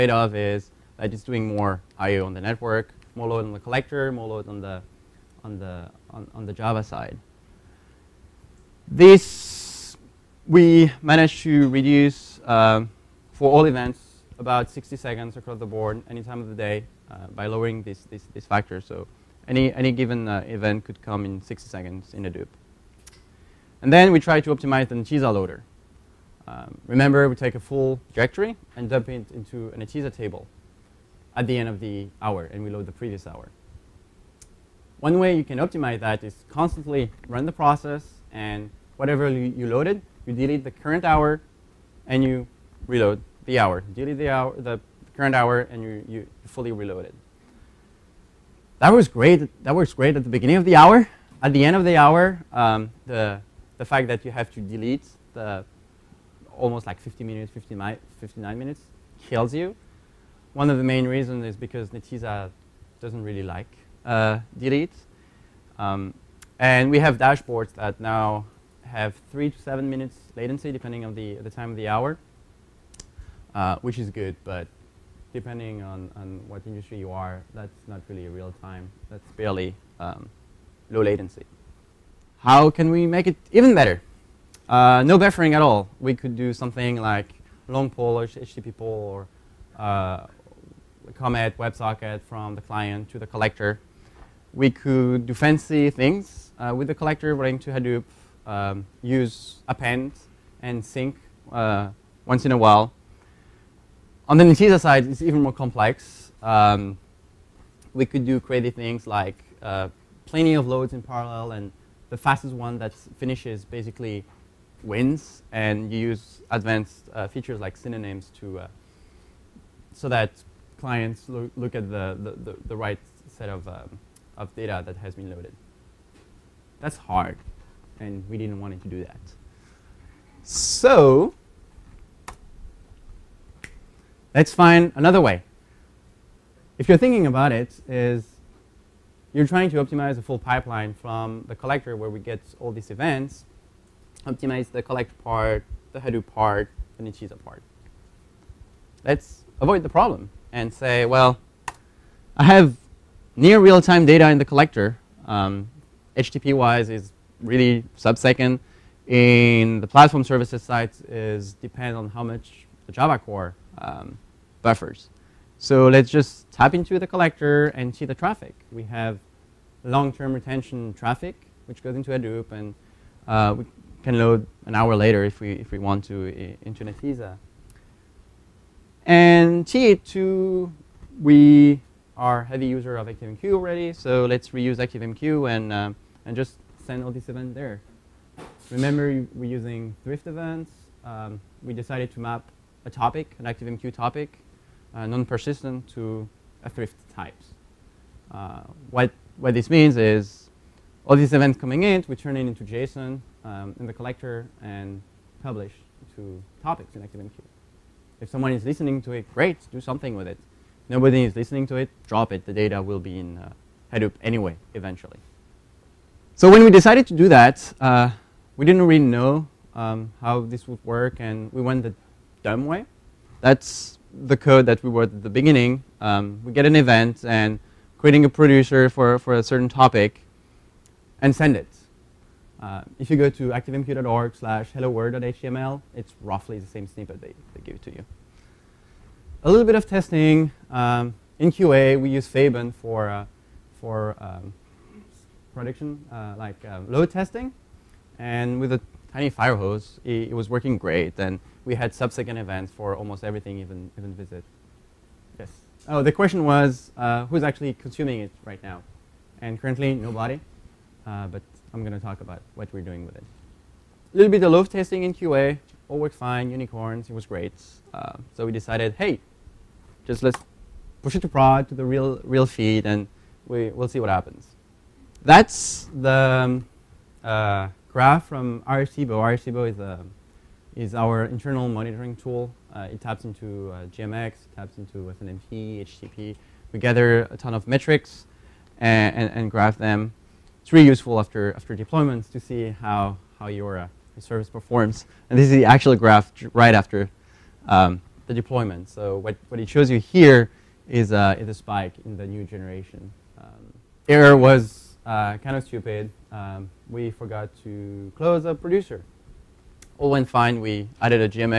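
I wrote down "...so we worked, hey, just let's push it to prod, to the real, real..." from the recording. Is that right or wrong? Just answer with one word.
wrong.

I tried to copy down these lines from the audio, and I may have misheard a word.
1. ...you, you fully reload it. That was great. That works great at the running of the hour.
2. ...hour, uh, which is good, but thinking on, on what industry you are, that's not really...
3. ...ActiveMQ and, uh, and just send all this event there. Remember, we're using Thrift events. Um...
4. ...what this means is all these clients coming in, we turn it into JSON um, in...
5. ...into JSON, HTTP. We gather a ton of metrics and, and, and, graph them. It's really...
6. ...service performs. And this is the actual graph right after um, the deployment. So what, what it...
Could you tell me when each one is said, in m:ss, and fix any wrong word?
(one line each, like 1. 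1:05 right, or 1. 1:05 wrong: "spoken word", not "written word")
1. 0:45 wrong: "beginning", not "running"
2. 1:11 wrong: "depending", not "thinking"
3. 3:04 right
4. 3:19 wrong: "events", not "clients"
5. 4:44 wrong: "SNMP", not "JSON"
6. 4:54 right.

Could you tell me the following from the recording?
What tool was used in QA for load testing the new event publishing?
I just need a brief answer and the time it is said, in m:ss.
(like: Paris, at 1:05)
Faban, at 4:02.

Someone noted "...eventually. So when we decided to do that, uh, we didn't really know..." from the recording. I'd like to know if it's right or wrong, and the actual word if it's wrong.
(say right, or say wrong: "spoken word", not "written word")
right.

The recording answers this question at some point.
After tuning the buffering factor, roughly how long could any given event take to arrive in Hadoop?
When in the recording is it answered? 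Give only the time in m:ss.
0:21.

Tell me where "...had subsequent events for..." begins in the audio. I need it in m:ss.
4:11.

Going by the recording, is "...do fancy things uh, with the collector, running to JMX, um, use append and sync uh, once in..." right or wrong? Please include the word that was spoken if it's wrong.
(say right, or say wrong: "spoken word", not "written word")
wrong: "Hadoop", not "JMX".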